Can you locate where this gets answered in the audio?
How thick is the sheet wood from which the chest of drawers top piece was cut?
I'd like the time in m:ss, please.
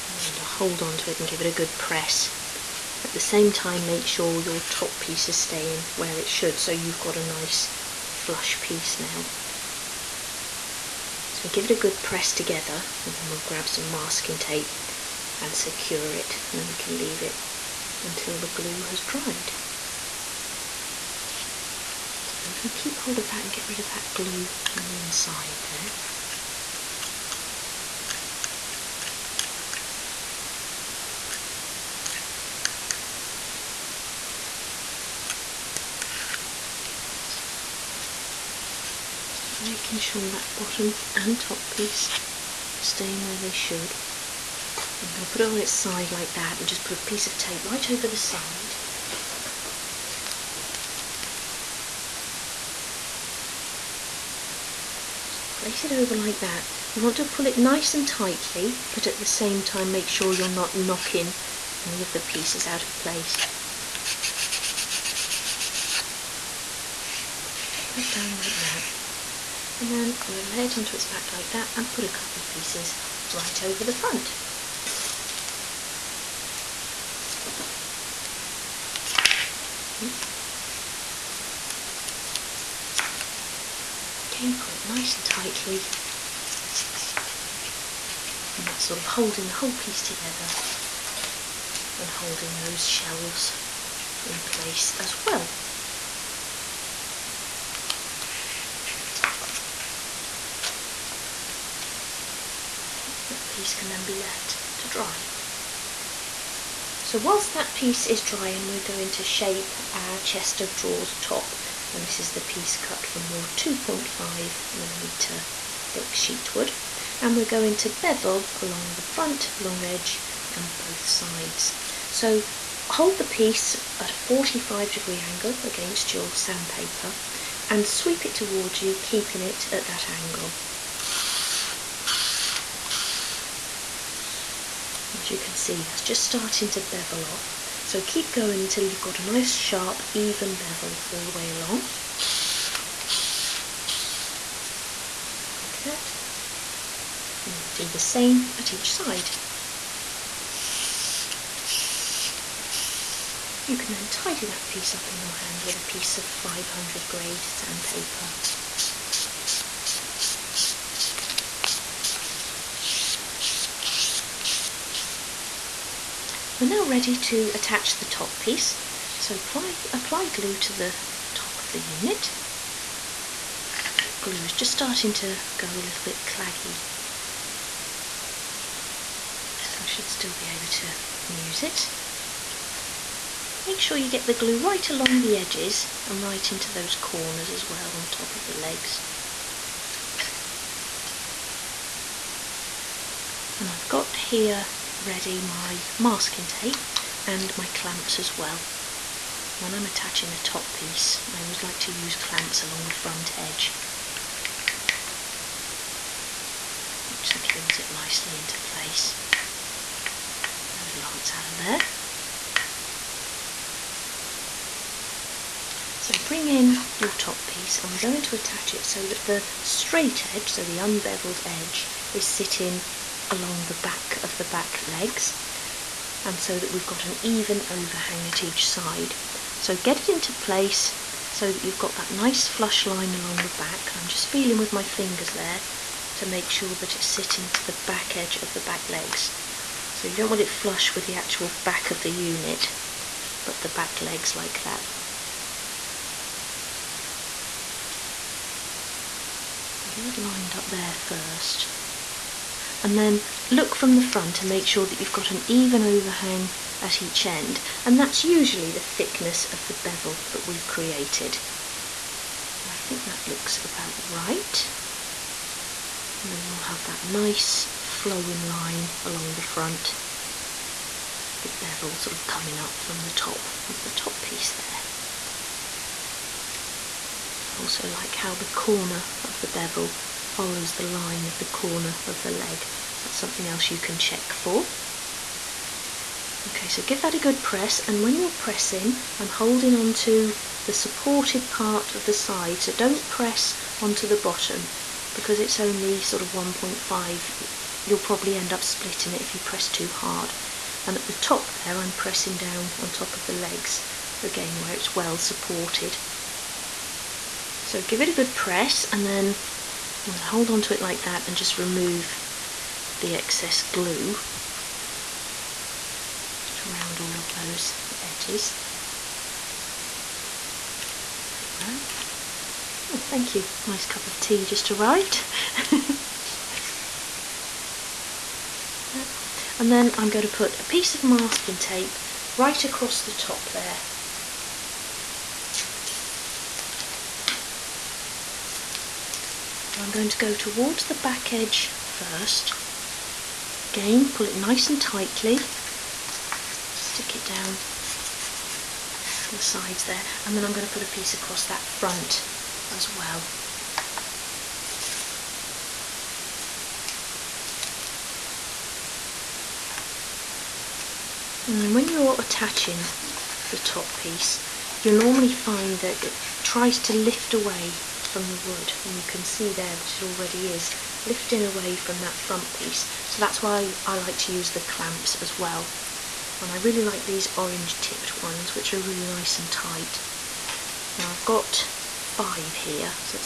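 1:53.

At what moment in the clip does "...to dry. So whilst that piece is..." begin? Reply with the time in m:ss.
1:44.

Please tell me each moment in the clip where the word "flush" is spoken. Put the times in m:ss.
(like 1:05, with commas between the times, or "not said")
0:08, 3:52, 4:00.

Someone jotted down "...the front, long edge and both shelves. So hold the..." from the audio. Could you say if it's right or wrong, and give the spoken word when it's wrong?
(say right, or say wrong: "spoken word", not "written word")
wrong: "sides", not "shelves".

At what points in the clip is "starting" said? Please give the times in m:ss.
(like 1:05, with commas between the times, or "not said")
2:16, 2:54.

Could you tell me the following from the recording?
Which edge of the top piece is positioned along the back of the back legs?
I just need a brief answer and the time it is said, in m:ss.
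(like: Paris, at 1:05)
the unbeveled edge, at 3:40.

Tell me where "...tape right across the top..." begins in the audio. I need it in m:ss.
5:31.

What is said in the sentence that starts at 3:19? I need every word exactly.
When I'm attaching a top piece, I always like to use clamps along the front edge, which secures it nicely into place.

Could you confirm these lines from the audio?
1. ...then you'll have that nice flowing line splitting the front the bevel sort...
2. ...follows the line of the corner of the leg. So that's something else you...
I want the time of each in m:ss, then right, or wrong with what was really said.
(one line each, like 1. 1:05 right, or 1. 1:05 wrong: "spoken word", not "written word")
1. 4:26 wrong: "along", not "splitting"
2. 4:40 right.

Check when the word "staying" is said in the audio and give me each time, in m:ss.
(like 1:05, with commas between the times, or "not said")
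0:05, 0:42.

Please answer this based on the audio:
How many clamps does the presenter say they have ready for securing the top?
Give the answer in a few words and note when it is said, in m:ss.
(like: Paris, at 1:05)
5, at 6:21.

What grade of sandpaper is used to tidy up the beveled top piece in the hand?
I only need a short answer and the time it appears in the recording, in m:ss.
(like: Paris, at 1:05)
500, at 2:36.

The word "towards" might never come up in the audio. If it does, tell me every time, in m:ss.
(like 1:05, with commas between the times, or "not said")
2:08, 5:40.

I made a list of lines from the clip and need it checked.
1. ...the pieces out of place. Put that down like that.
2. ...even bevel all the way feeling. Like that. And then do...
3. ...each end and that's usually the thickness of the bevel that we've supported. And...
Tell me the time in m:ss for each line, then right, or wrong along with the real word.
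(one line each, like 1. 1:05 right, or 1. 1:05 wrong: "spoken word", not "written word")
1. 1:02 right
2. 2:20 wrong: "along", not "feeling"
3. 4:17 wrong: "created", not "supported".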